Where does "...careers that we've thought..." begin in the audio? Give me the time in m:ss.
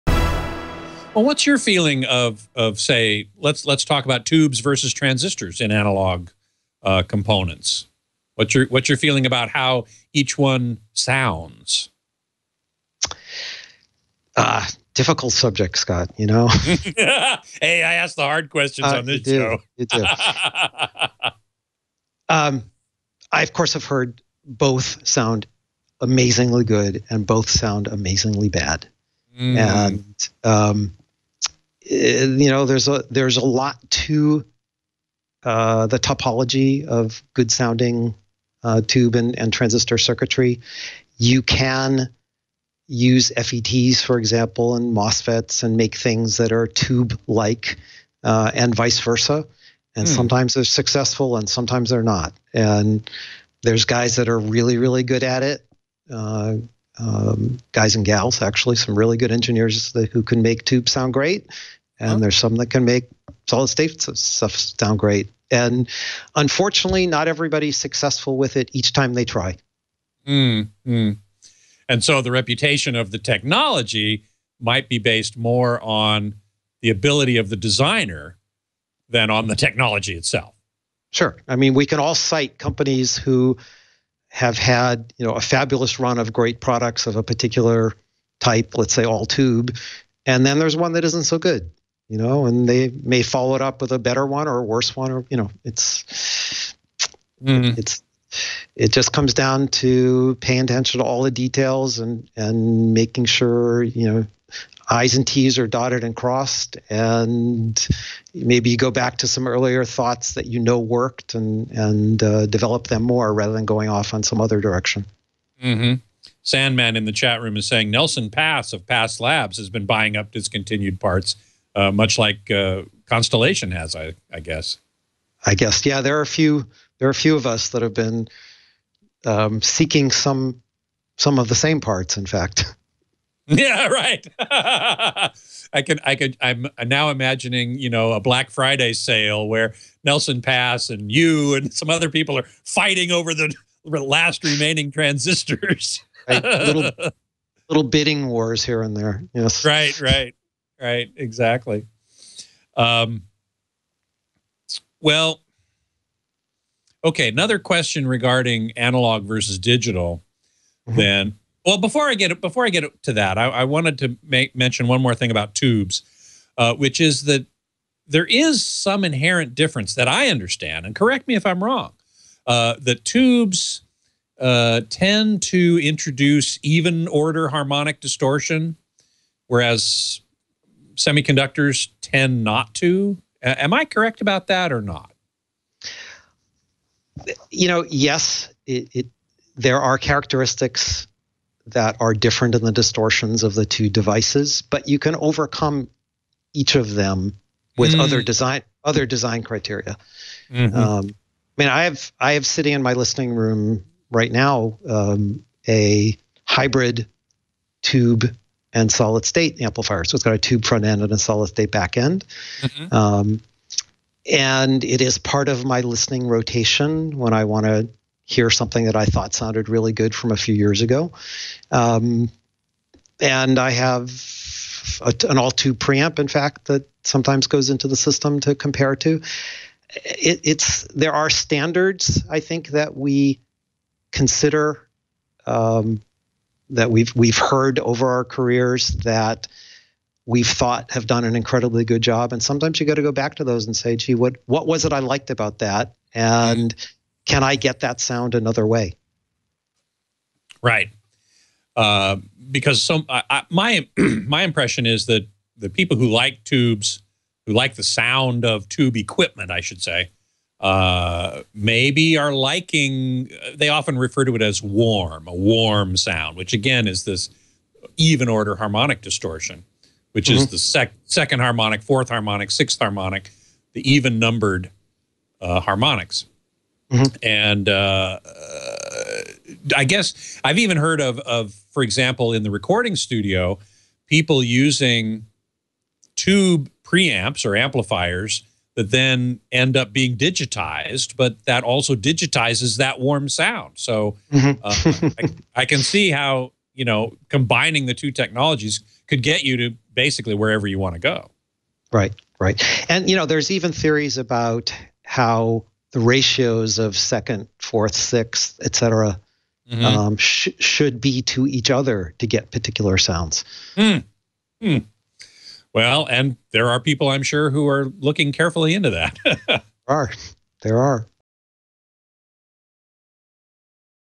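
3:58.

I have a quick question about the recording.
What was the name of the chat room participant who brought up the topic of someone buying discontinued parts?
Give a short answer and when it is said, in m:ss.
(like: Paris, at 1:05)
sandman, at 1:56.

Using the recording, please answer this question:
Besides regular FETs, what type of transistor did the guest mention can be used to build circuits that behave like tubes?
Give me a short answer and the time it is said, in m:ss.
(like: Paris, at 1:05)
MOSFETs, at 0:44.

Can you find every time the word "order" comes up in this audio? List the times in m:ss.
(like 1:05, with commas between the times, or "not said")
2:57, 4:28.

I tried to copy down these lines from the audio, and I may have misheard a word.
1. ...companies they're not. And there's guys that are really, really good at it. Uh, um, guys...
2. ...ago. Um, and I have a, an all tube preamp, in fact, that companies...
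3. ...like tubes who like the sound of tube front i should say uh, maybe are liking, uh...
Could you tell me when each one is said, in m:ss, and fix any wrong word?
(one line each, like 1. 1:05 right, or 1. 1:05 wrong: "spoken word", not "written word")
1. 0:51 wrong: "sometimes", not "companies"
2. 3:40 wrong: "sometimes", not "companies"
3. 4:16 wrong: "equipment", not "front".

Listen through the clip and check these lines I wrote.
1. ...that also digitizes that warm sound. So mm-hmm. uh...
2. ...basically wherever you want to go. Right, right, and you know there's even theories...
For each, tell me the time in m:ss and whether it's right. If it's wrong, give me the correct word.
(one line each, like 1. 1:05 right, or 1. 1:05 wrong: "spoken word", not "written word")
1. 4:51 right
2. 4:59 right.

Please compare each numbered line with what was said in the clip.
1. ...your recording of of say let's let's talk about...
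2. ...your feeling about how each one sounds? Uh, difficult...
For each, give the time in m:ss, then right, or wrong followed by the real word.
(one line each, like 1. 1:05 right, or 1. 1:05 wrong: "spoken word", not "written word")
1. 0:01 wrong: "feeling", not "recording"
2. 0:08 right.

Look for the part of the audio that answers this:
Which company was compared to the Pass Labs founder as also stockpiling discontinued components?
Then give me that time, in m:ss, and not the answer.
2:03.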